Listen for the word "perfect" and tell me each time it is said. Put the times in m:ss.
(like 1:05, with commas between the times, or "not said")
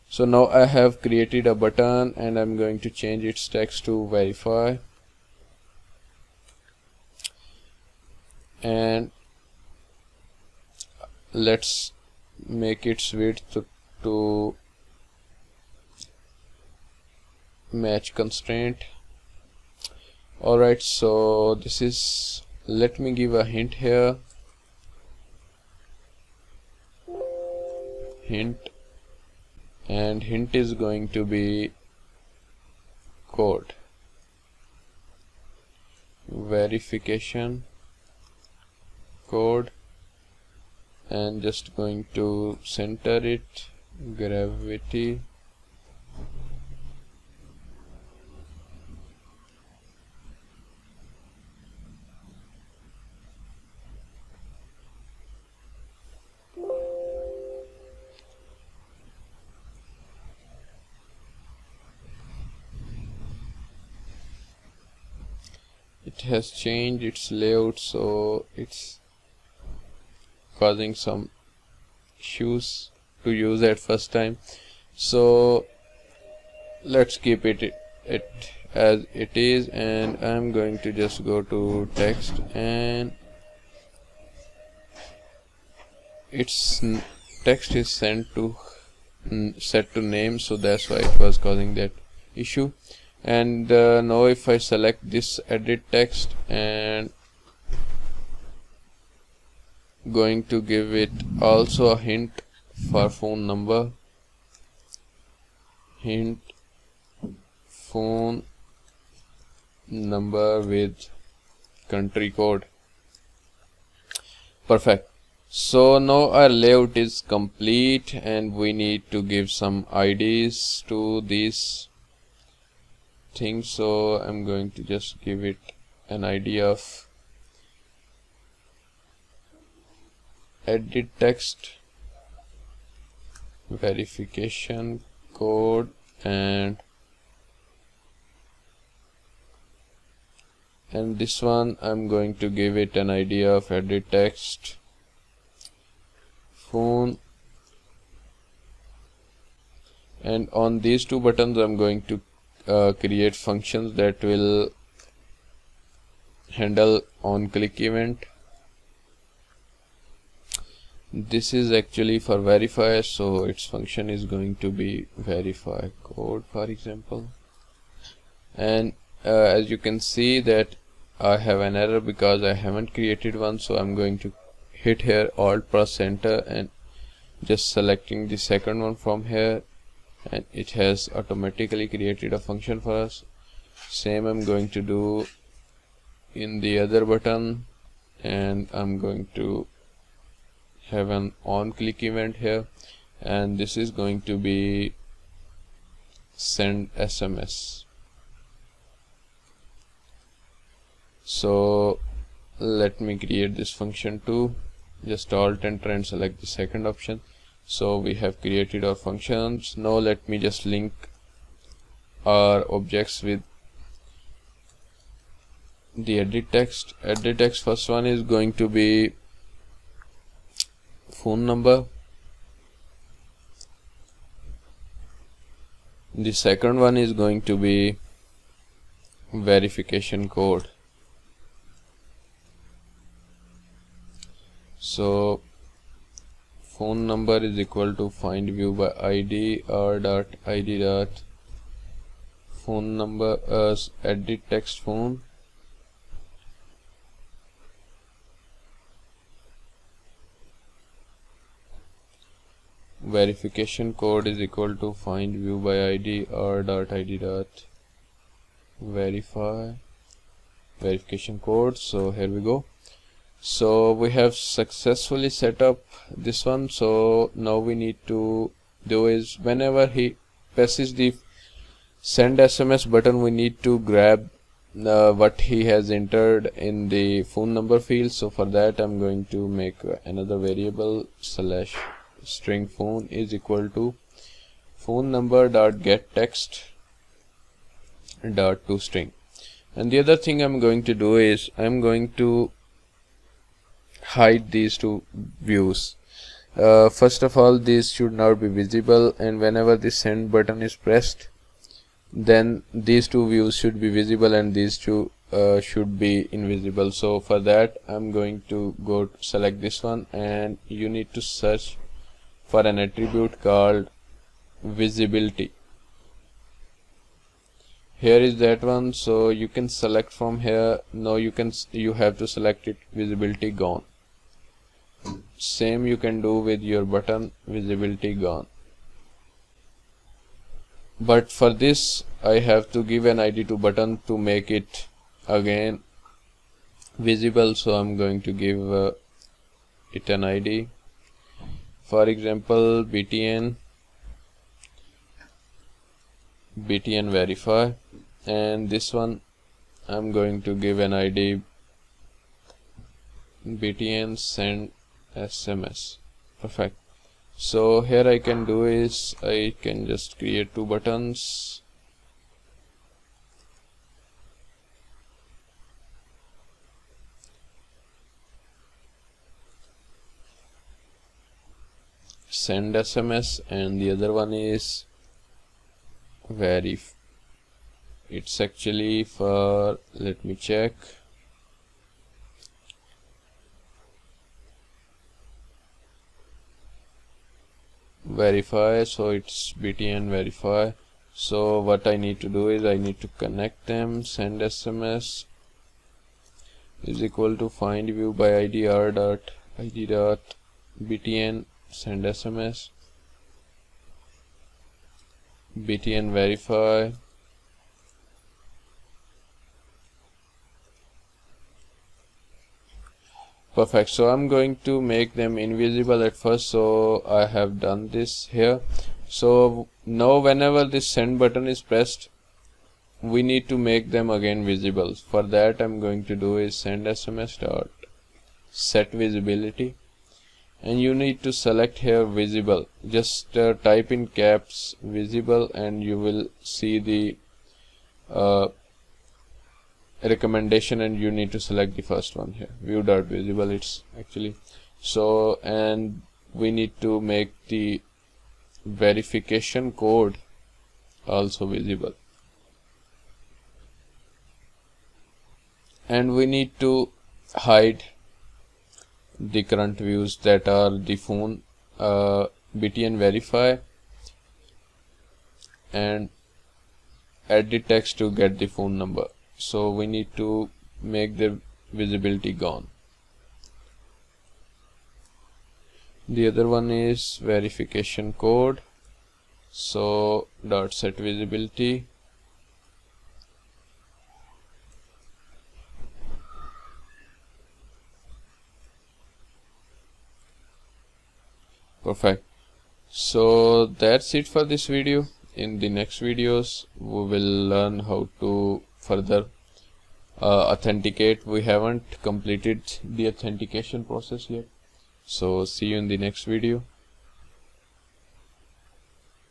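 1:54, 5:56, 6:53, 8:11.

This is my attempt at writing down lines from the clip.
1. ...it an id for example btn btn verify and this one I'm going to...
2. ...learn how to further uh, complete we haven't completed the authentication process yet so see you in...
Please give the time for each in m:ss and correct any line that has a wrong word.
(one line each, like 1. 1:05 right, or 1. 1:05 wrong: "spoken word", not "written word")
1. 5:39 right
2. 8:17 wrong: "authenticate", not "complete".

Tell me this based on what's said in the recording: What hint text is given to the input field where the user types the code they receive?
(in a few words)
code verification code.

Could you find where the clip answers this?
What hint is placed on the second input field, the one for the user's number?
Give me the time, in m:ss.
1:47.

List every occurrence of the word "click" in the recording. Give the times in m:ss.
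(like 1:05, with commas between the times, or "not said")
2:37, 3:11.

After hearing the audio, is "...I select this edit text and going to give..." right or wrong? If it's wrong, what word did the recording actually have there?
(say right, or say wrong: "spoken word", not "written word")
right.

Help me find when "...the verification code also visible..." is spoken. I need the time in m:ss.
7:27.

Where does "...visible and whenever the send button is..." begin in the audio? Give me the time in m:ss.
4:58.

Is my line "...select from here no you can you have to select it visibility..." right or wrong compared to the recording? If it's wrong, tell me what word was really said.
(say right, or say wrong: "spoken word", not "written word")
right.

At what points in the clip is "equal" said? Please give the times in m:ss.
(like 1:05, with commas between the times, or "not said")
3:57, 4:14, 4:43, 6:37.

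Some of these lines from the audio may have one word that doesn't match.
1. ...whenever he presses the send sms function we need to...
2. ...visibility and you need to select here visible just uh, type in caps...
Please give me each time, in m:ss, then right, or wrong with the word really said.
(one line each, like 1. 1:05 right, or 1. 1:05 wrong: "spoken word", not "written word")
1. 4:29 wrong: "button", not "function"
2. 7:09 right.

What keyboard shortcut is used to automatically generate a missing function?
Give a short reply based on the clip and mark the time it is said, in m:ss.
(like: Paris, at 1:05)
alt plus enter, at 2:55.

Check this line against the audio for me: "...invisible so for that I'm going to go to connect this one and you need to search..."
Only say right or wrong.
wrong.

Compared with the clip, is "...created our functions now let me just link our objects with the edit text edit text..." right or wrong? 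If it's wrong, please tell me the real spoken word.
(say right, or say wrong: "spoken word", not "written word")
right.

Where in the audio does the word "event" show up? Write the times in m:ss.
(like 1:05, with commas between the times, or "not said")
2:37, 3:12.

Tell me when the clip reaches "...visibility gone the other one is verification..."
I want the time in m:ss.
7:51.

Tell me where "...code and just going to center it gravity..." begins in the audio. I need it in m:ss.
0:39.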